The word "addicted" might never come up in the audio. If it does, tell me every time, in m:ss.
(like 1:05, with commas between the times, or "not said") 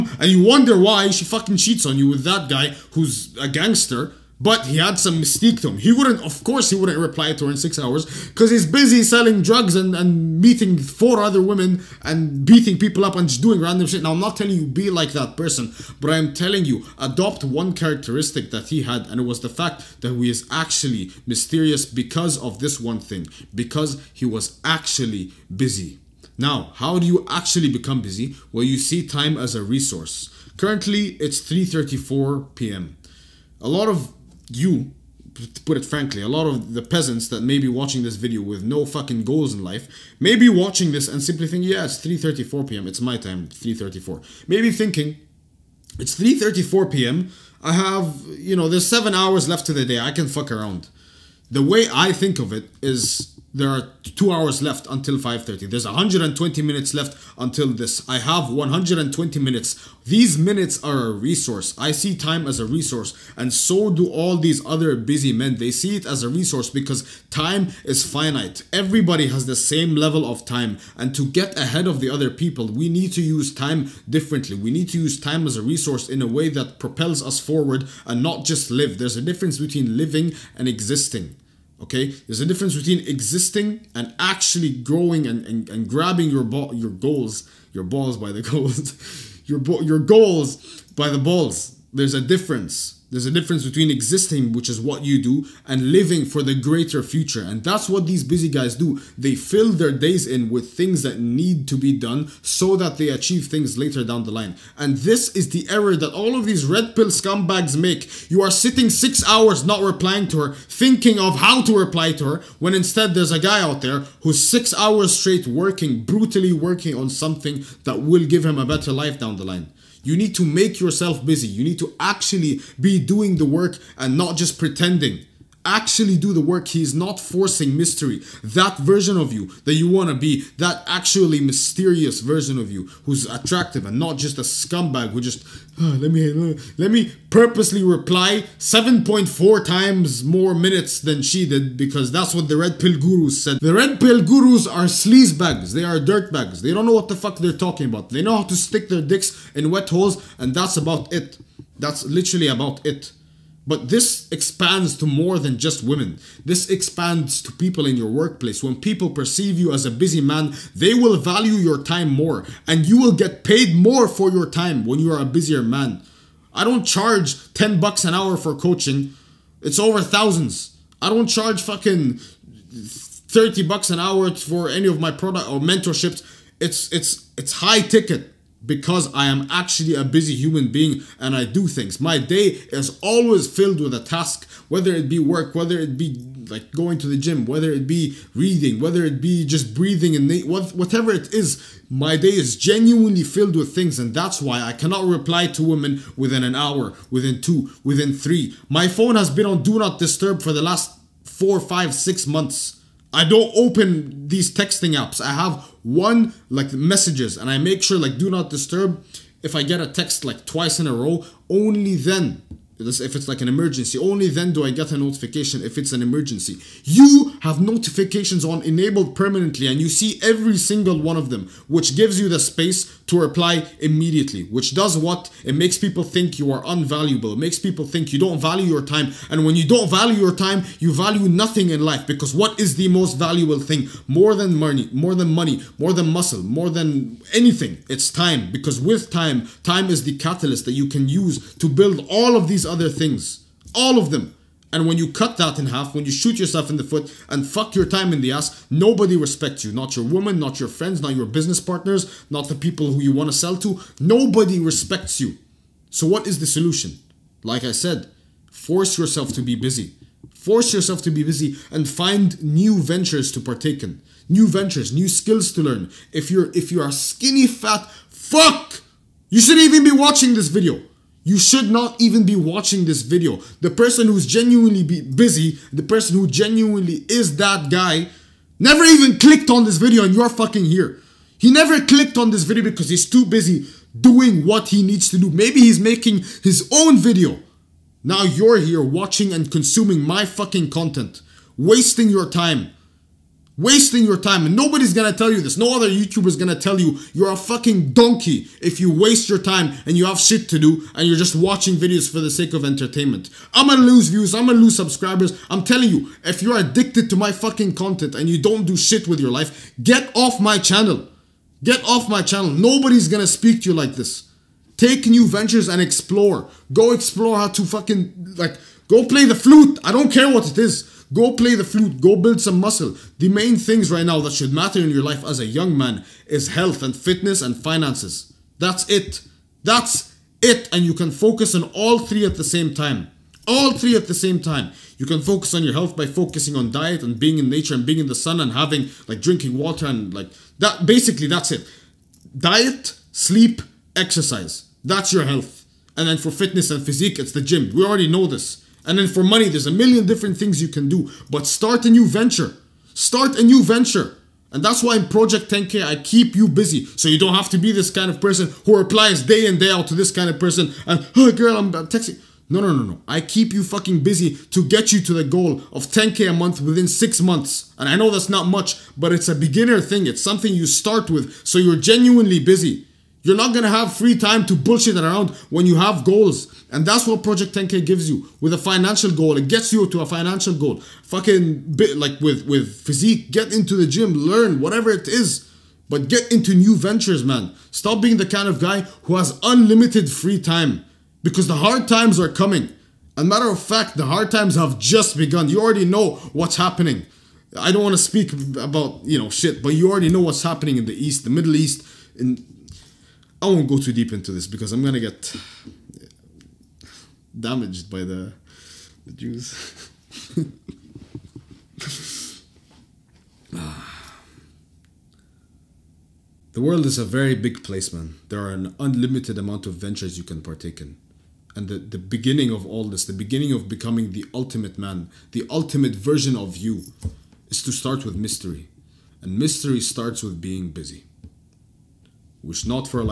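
5:06.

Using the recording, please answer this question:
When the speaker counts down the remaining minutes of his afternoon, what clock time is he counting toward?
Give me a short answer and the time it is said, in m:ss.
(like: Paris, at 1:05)
5:30, at 0:55.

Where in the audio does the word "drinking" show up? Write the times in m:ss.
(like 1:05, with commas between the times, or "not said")
5:39.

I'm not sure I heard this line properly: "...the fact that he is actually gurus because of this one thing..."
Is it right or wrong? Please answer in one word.
wrong.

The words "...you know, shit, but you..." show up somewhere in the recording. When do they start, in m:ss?
6:39.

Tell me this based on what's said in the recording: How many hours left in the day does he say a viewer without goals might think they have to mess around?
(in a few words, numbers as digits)
7.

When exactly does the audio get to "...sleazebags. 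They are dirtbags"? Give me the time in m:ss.
2:24.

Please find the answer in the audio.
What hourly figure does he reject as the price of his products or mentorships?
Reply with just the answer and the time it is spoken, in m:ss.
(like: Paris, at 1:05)
30 bucks, at 2:52.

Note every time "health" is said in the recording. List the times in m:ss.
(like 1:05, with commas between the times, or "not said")
5:26, 5:35, 5:45.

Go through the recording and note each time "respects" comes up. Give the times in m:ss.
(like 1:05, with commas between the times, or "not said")
4:09, 4:14.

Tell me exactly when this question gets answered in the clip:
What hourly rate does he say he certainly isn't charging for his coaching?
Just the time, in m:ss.
2:47.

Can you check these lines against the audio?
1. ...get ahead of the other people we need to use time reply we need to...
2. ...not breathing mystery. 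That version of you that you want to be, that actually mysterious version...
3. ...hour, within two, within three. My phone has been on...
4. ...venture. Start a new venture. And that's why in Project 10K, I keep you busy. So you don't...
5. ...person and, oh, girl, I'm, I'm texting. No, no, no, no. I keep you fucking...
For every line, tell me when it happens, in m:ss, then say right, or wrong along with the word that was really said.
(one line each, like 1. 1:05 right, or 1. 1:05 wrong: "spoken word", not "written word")
1. 1:11 wrong: "differently", not "reply"
2. 2:06 wrong: "forcing", not "breathing"
3. 3:16 right
4. 5:52 right
5. 6:00 right.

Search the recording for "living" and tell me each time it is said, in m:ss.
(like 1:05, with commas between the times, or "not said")
1:19, 1:35.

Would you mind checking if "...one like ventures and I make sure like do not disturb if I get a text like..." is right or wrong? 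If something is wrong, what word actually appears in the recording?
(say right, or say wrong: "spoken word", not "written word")
wrong: "messages", not "ventures".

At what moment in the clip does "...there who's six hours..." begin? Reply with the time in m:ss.
1:53.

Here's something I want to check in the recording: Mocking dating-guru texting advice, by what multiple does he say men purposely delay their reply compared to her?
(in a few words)
7.4 times.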